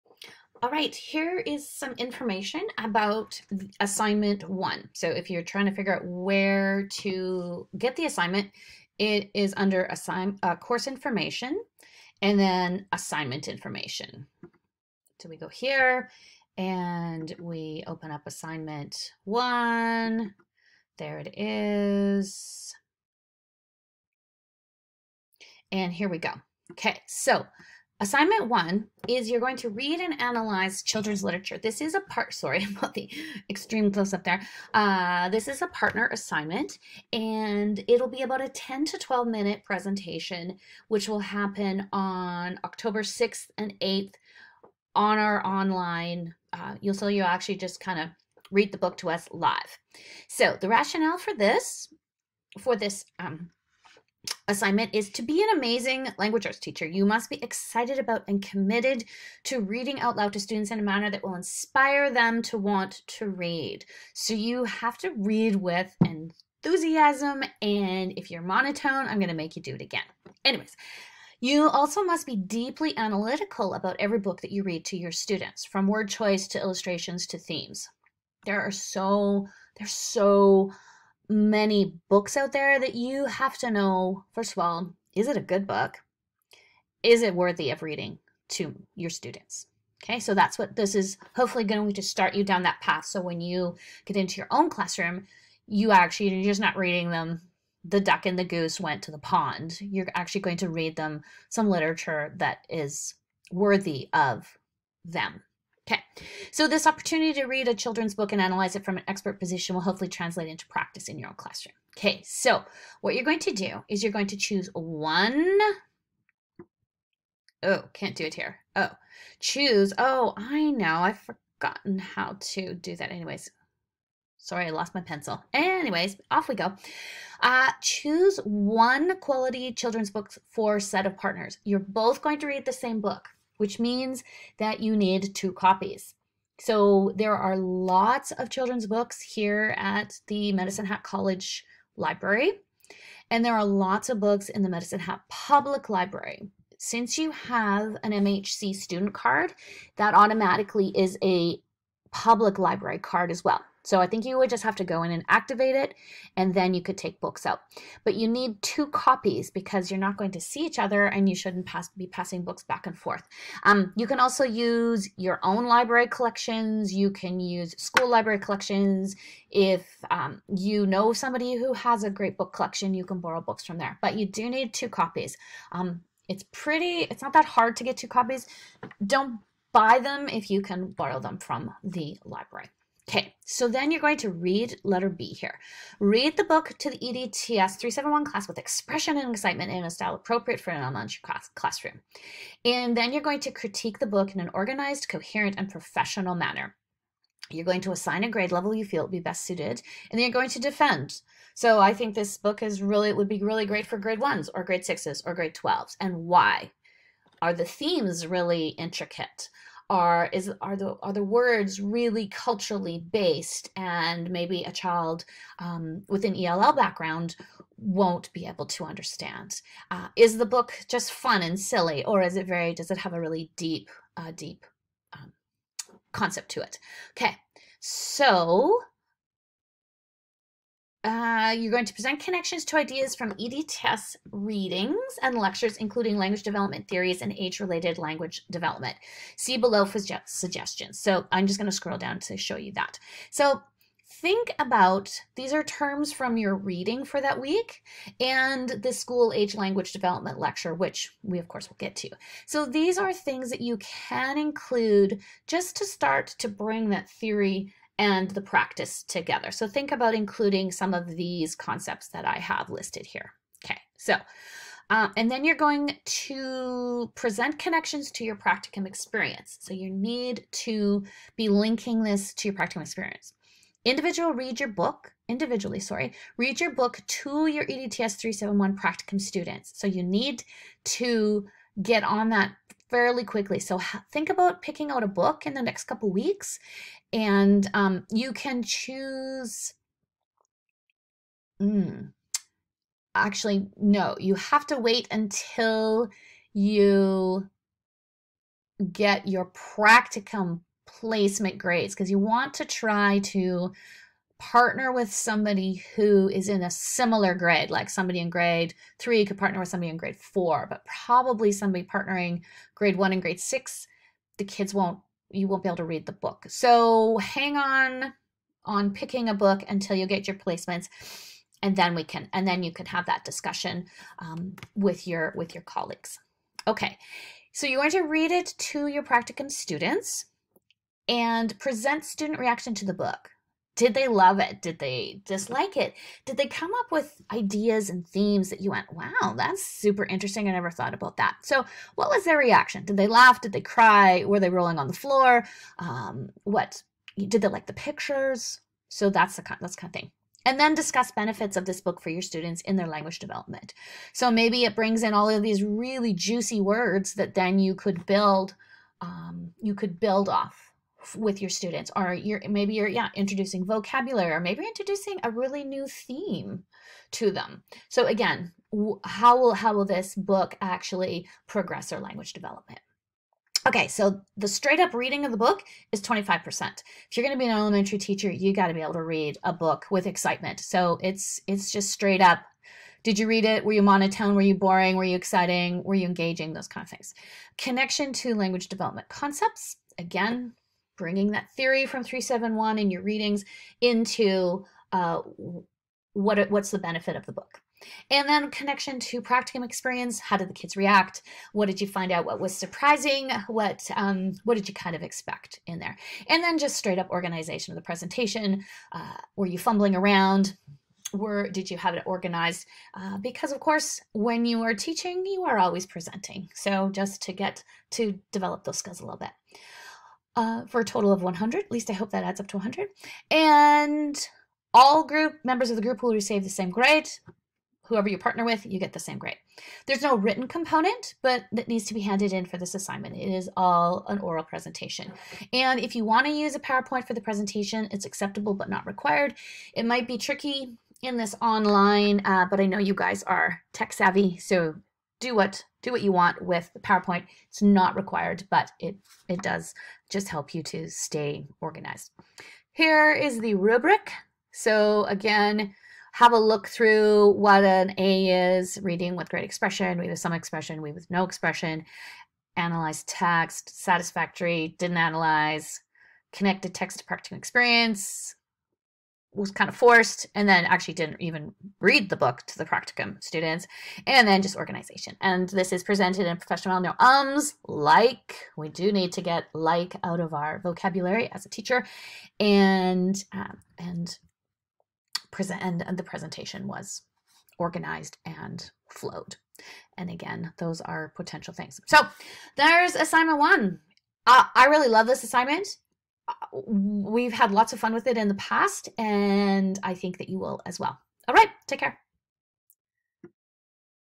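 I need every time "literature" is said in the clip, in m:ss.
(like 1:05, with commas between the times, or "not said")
0:31, 1:41.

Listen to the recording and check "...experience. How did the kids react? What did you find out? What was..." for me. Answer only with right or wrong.
right.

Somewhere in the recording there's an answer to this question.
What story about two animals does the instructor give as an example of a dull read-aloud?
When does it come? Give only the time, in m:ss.
1:37.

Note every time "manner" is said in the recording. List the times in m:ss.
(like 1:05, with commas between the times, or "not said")
1:00, 3:16.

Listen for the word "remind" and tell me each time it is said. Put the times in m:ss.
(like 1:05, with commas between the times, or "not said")
not said.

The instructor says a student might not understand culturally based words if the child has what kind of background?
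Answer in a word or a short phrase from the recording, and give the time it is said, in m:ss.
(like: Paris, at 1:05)
ELL, at 3:36.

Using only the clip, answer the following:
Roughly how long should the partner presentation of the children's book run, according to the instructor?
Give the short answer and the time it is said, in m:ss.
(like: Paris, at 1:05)
10 to 12 minutes, at 0:38.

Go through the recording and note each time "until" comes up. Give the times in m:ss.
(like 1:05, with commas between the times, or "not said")
4:55, 5:19.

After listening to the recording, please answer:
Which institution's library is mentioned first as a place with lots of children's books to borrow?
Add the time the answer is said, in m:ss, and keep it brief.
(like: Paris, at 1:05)
Medicine Hat College Library, at 2:20.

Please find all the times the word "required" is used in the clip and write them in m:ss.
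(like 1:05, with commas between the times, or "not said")
7:18, 7:27.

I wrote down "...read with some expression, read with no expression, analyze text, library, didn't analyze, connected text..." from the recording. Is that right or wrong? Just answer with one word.
wrong.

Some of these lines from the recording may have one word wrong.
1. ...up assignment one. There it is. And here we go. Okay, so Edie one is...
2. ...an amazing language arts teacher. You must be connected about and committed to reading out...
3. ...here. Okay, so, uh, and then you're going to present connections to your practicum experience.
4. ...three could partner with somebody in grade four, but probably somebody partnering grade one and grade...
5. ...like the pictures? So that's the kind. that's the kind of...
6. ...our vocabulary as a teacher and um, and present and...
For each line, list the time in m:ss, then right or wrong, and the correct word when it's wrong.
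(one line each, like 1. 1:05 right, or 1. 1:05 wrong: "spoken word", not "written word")
1. 0:18 wrong: "Assignment", not "Edie"
2. 0:55 wrong: "excited", not "connected"
3. 4:23 right
4. 5:08 right
5. 5:47 right
6. 8:00 right.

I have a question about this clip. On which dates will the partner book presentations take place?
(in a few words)
October 6th and 8th.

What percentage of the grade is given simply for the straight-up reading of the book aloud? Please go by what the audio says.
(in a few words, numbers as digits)
25%.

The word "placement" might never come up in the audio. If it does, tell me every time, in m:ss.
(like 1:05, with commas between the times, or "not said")
5:00, 5:20.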